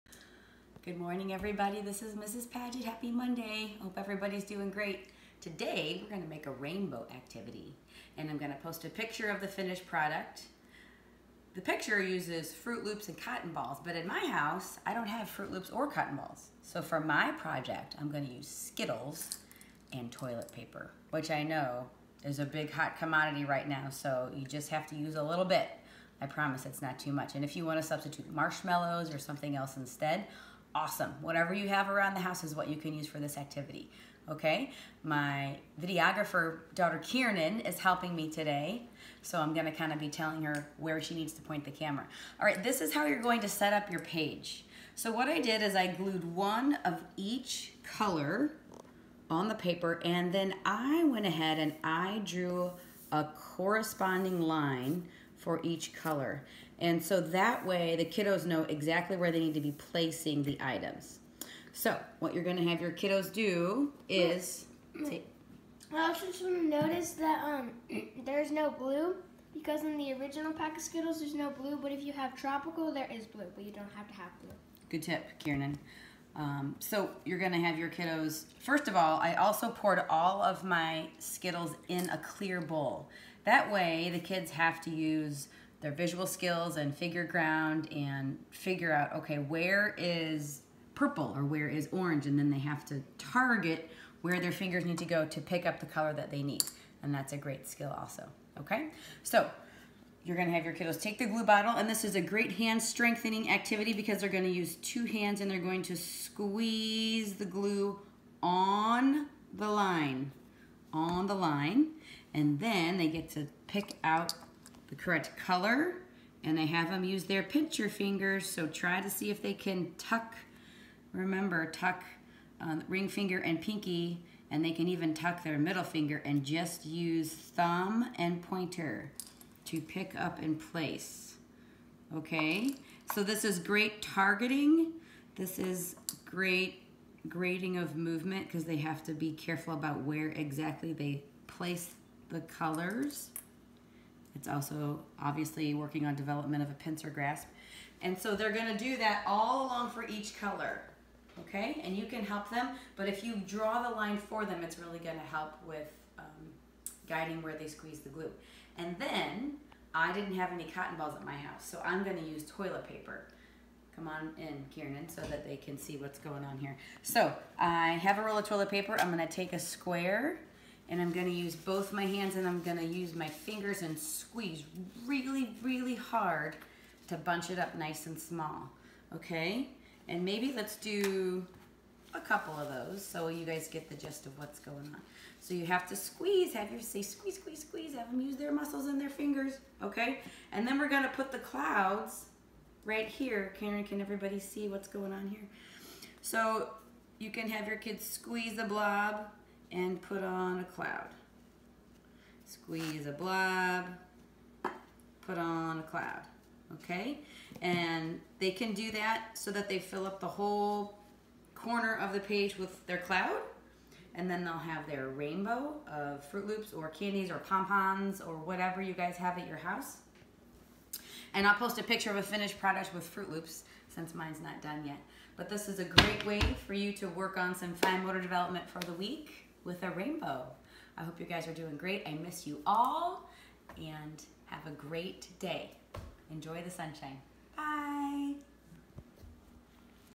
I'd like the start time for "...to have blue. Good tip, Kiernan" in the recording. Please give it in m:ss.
1:14.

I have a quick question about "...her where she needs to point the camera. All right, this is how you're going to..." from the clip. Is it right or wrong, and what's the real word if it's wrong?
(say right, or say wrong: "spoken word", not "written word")
right.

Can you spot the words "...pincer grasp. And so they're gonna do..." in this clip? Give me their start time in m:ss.
2:26.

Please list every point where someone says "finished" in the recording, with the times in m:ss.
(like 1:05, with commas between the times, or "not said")
0:09, 3:42.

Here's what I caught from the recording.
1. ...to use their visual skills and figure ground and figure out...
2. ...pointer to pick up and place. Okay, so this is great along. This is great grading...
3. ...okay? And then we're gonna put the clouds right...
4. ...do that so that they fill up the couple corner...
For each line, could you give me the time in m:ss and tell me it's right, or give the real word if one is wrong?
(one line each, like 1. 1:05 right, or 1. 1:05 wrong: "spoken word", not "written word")
1. 1:24 right
2. 2:08 wrong: "targeting", not "along"
3. 3:09 right
4. 3:28 wrong: "whole", not "couple".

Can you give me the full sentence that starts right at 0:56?
And so that way the kiddos know exactly where they need to be placing the items.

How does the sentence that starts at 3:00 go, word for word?
And maybe let's do a couple of those so you guys get the gist of what's going on.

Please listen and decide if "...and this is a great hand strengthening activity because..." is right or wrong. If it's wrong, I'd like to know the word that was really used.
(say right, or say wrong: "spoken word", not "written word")
right.